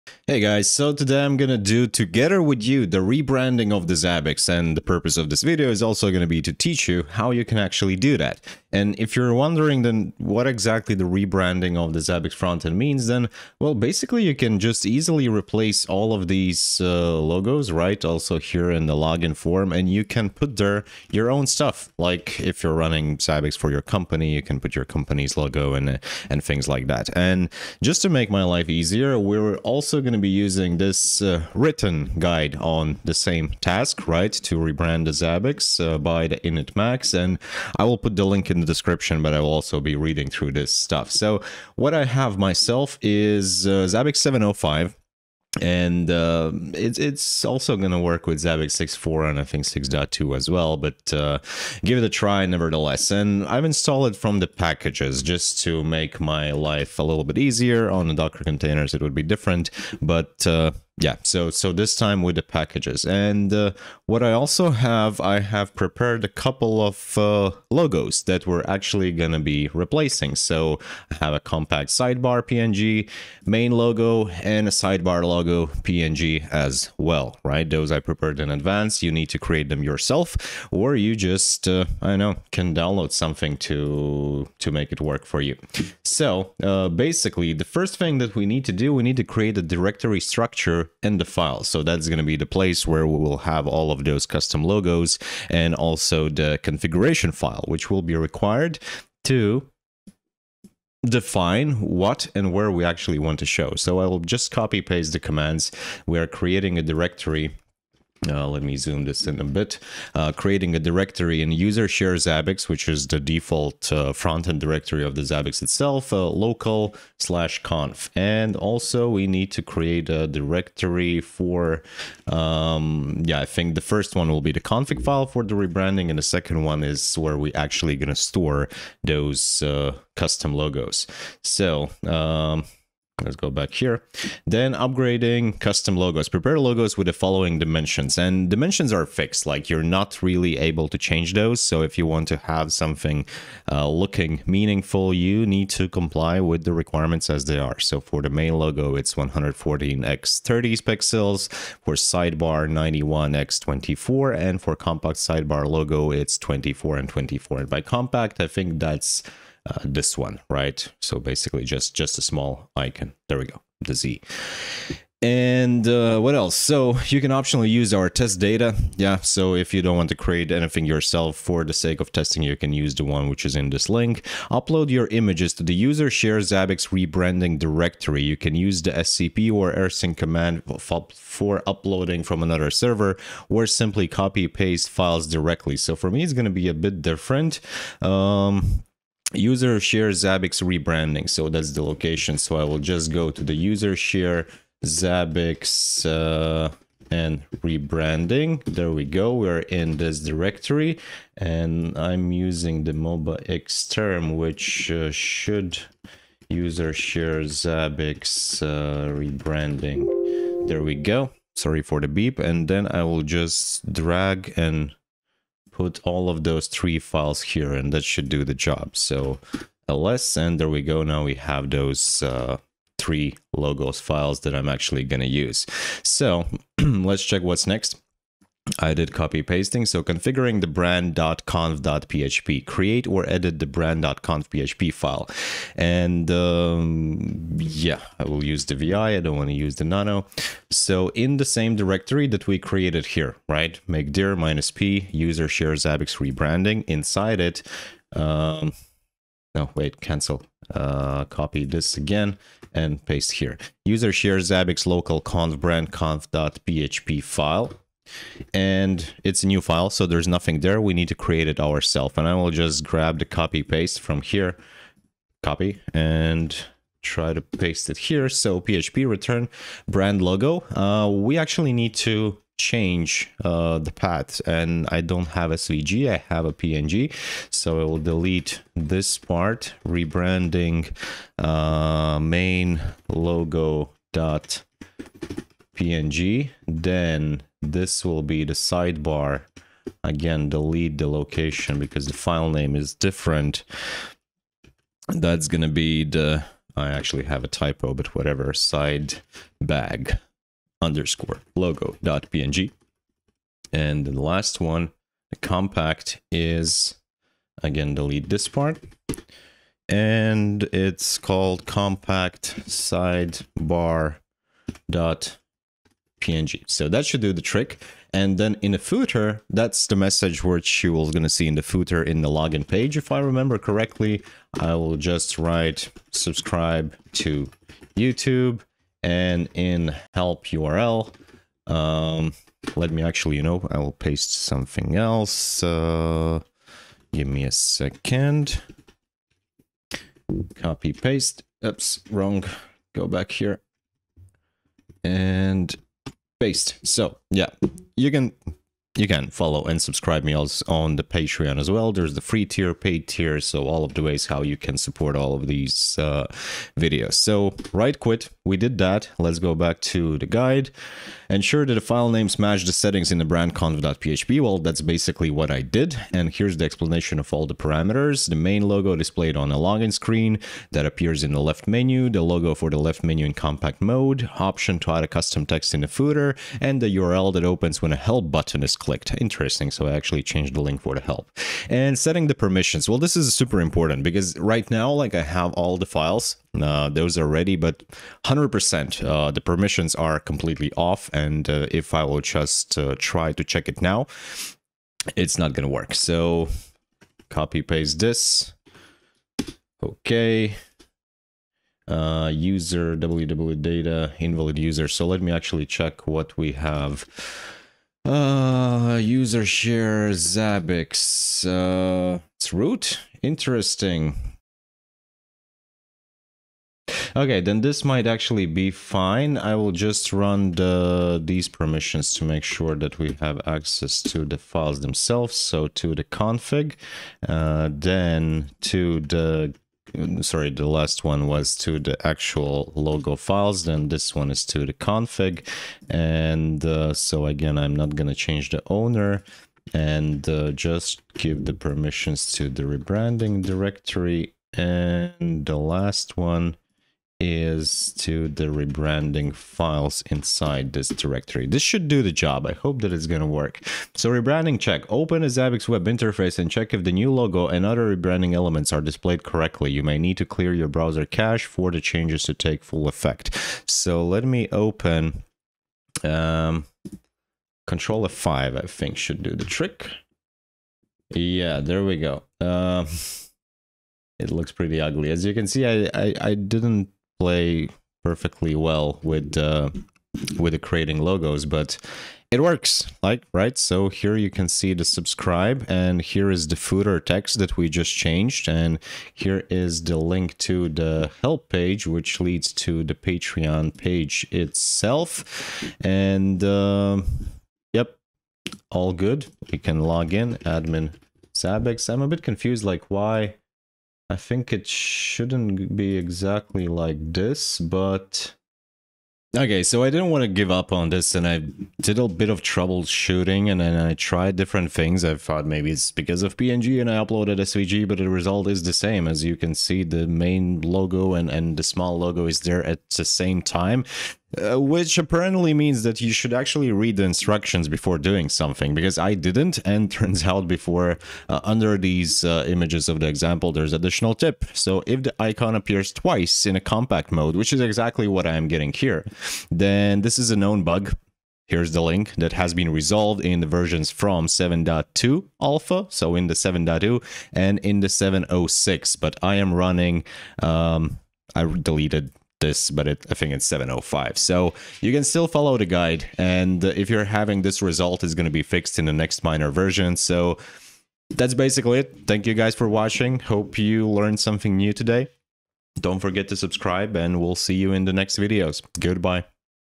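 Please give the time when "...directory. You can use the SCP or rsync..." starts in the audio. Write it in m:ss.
2:57.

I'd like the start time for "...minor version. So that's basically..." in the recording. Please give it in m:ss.
9:19.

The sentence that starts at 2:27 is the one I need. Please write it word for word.
So for the main logo, it's 114 x 30 pixels.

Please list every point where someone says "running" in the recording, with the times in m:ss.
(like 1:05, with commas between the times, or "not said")
0:22, 9:09.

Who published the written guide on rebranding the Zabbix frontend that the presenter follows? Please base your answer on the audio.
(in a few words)
initMAX.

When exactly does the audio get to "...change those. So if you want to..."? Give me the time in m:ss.
2:20.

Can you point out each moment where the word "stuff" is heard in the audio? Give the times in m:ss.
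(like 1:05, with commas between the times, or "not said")
0:21, 0:40.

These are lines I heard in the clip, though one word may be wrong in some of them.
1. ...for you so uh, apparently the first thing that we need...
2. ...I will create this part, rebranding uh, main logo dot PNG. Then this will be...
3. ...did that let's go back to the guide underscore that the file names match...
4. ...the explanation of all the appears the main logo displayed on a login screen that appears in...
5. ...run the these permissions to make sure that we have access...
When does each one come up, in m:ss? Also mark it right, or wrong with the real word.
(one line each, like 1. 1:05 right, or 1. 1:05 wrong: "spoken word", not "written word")
1. 1:25 wrong: "basically", not "apparently"
2. 4:37 wrong: "delete", not "create"
3. 5:58 wrong: "ensure", not "underscore"
4. 6:06 wrong: "parameters", not "appears"
5. 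7:00 right.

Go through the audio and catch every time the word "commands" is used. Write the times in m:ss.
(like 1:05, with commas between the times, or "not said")
1:45, 3:00.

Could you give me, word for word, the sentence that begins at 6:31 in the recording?
And uh, if I will just uh, try to check it now, it's not going to work.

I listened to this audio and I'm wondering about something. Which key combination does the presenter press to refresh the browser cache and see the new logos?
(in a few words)
Control F5.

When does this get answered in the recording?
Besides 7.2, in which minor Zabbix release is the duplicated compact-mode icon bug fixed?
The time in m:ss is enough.
9:07.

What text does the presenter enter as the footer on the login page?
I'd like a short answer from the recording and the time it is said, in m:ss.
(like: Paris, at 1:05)
Subscribe to YouTube, at 5:26.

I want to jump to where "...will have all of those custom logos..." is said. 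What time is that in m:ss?
1:33.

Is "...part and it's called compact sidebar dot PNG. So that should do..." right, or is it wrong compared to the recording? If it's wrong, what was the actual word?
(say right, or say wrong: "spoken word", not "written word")
right.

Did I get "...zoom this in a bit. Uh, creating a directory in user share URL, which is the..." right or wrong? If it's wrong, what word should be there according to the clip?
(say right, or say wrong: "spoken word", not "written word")
wrong: "Zabbix", not "URL".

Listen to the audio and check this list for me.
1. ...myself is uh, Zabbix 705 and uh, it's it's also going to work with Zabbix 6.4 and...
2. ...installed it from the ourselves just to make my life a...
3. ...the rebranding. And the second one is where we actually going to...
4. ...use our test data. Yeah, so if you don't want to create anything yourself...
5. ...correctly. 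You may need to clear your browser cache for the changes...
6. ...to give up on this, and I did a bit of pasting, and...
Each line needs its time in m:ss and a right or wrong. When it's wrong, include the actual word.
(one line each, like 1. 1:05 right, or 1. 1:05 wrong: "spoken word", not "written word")
1. 0:42 right
2. 0:53 wrong: "packages", not "ourselves"
3. 2:05 right
4. 2:47 right
5. 7:39 right
6. 8:30 wrong: "troubleshooting", not "pasting".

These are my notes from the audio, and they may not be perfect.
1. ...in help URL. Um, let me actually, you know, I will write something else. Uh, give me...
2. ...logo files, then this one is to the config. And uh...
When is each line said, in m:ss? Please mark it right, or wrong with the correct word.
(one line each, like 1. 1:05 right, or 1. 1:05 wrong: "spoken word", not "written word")
1. 5:29 wrong: "paste", not "write"
2. 7:12 right.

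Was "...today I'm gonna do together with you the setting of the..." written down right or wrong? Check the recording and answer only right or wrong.
wrong.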